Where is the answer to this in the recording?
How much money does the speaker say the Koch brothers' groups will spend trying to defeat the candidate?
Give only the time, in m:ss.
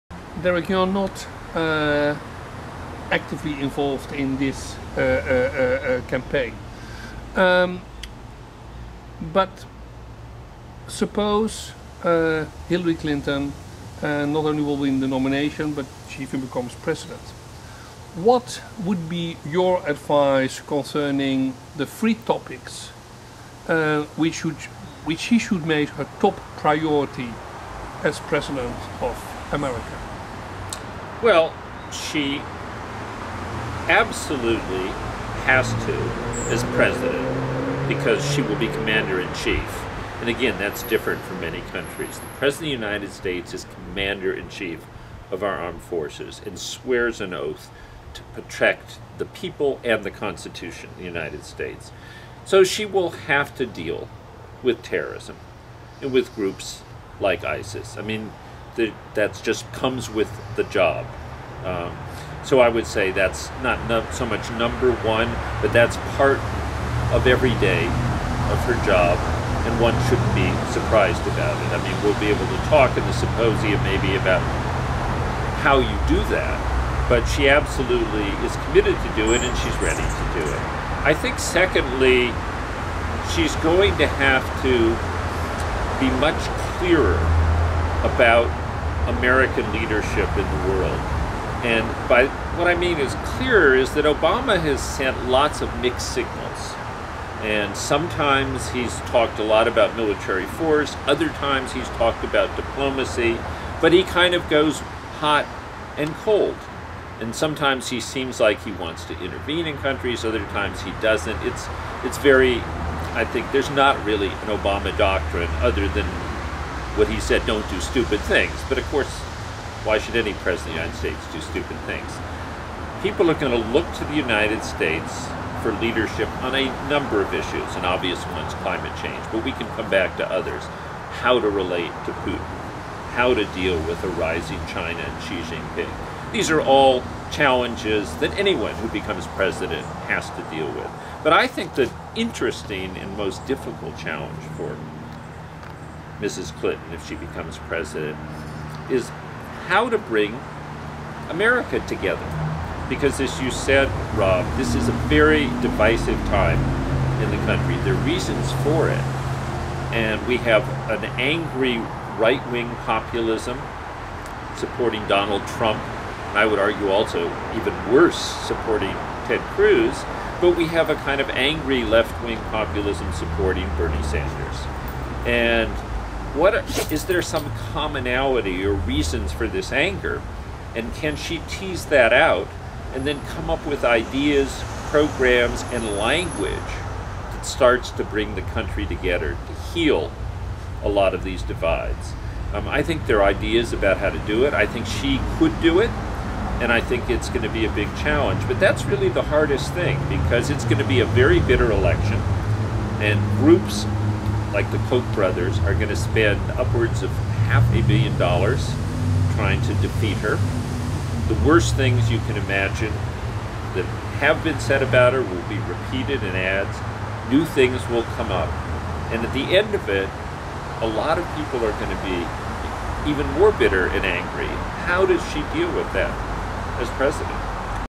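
3:27.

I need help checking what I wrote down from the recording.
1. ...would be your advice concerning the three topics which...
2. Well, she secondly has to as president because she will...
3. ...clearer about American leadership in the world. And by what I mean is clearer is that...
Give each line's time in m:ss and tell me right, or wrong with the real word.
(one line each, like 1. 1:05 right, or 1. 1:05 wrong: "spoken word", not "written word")
1. 0:18 right
2. 0:31 wrong: "absolutely", not "secondly"
3. 1:26 right.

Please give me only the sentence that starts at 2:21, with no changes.
But I think the interesting and most difficult challenge for Mrs.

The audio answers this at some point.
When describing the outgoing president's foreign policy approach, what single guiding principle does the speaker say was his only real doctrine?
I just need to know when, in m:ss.
1:57.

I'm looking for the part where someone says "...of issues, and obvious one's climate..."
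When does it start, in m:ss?
2:07.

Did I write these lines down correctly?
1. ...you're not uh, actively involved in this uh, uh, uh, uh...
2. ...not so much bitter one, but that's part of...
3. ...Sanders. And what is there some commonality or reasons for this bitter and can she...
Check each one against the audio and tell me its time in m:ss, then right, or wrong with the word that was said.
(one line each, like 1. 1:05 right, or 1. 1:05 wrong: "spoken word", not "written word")
1. 0:00 right
2. 1:03 wrong: "number", not "bitter"
3. 2:54 wrong: "anger", not "bitter".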